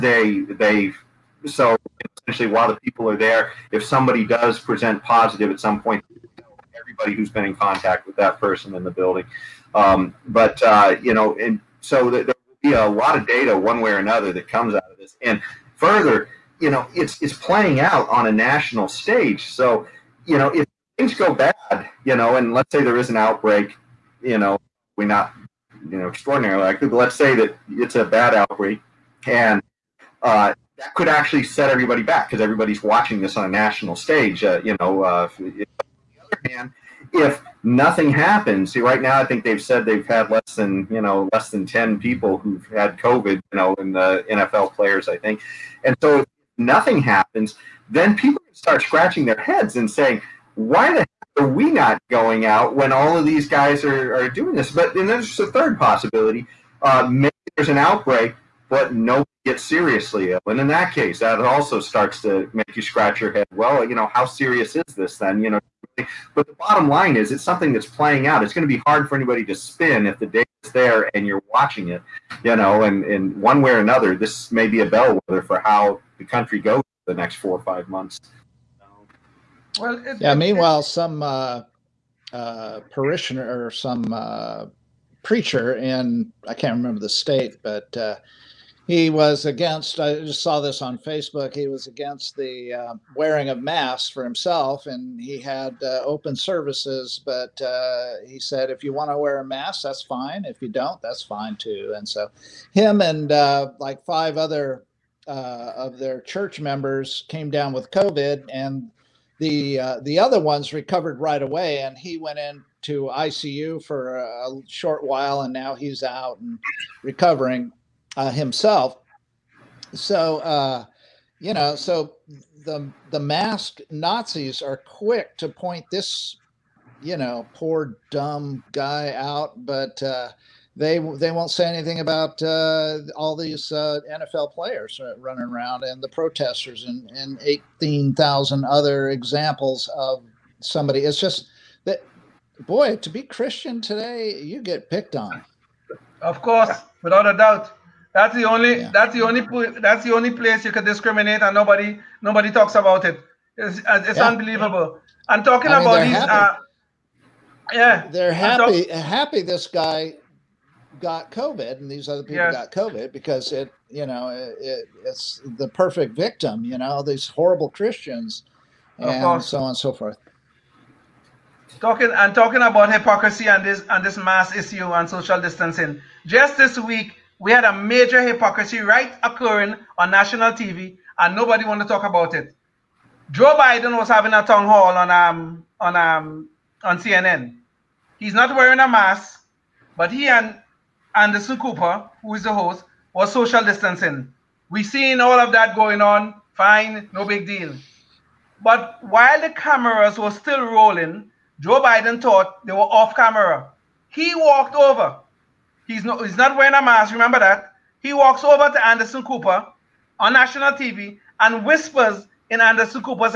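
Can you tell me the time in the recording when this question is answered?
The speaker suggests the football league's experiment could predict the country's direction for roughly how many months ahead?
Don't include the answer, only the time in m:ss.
1:17.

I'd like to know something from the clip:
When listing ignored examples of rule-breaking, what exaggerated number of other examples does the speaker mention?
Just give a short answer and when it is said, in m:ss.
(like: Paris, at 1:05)
18,000, at 2:17.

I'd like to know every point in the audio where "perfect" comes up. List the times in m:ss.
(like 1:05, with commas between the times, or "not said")
2:45.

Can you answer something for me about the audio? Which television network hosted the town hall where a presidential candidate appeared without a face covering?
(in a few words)
CNN.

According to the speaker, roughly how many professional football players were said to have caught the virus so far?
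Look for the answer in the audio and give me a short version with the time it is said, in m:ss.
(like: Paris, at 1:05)
less than 10, at 0:41.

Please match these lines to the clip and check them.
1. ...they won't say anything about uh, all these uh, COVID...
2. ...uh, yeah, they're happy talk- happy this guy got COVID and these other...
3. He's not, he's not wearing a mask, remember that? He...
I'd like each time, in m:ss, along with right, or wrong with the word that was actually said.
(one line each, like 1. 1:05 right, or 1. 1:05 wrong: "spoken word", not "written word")
1. 2:10 wrong: "NFL", not "COVID"
2. 2:36 right
3. 3:25 right.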